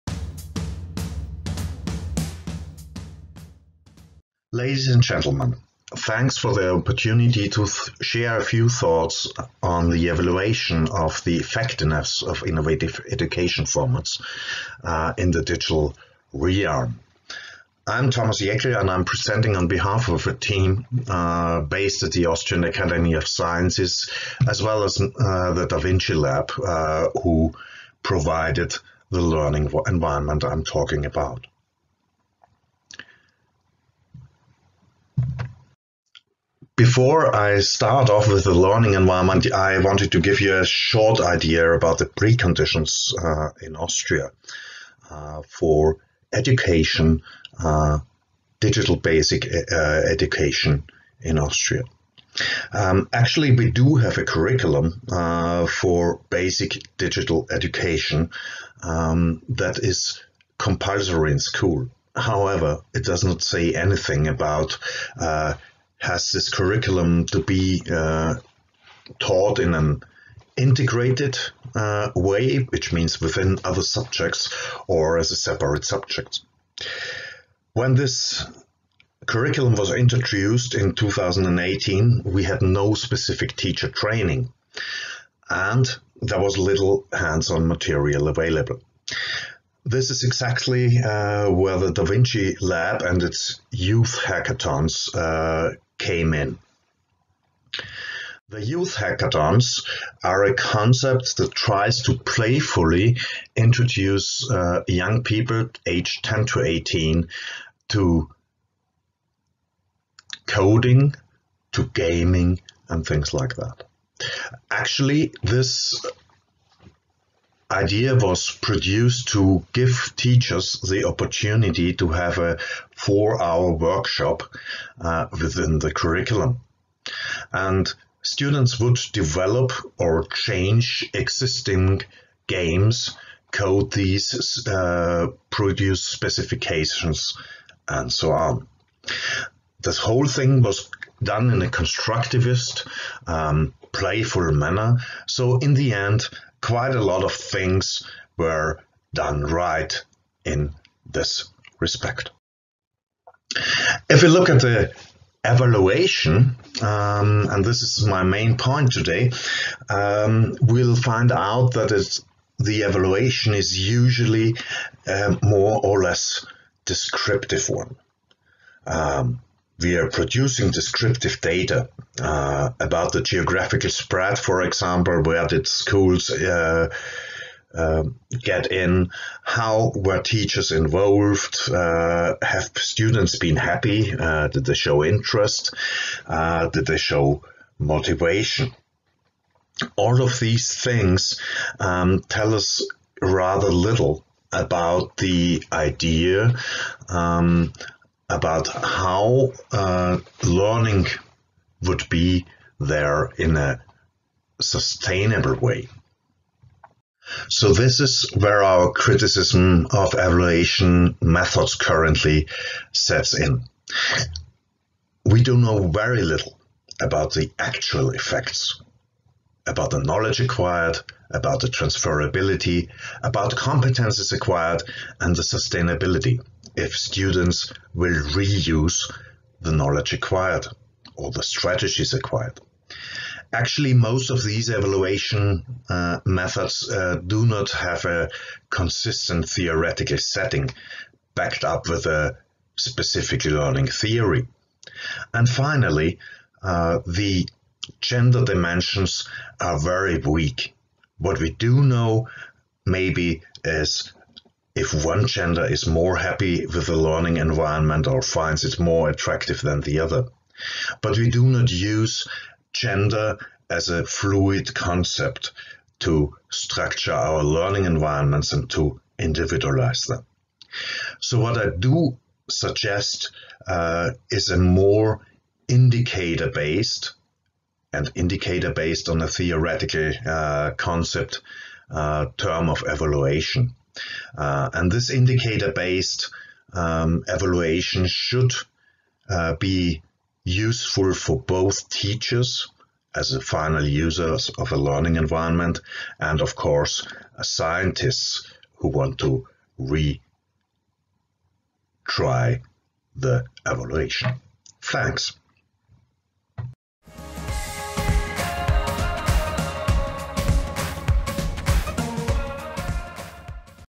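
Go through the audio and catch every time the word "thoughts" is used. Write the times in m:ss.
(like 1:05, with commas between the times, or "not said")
0:08.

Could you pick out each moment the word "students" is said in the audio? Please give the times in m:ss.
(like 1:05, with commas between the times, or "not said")
2:08, 3:02, 3:46.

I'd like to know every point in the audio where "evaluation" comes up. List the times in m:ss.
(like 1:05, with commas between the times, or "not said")
0:10, 2:35, 2:42, 3:30, 3:54, 4:42, 4:47, 5:03.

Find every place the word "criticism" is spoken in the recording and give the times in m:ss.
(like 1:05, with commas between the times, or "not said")
3:28.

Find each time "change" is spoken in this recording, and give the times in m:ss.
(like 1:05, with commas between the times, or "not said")
2:10.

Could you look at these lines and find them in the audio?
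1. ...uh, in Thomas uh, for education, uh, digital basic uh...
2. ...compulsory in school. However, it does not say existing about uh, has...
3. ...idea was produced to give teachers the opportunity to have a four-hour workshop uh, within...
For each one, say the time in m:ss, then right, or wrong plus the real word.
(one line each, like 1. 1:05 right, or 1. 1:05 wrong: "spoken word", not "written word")
1. 0:43 wrong: "Austria", not "Thomas"
2. 1:00 wrong: "anything", not "existing"
3. 1:57 right.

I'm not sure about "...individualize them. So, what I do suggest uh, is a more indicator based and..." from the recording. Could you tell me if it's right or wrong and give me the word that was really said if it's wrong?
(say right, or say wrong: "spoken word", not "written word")
right.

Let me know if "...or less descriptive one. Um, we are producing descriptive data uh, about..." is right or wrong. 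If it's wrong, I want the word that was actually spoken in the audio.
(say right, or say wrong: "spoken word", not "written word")
right.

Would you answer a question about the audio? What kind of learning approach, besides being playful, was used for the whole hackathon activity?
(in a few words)
constructivist.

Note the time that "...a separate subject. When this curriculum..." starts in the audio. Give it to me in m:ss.
1:15.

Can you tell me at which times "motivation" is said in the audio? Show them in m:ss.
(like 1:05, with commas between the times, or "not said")
3:07.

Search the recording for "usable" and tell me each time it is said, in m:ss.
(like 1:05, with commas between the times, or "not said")
not said.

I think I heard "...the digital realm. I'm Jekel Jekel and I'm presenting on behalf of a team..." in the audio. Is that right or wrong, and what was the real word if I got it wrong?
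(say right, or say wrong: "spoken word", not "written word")
wrong: "Thomas", not "Jekel".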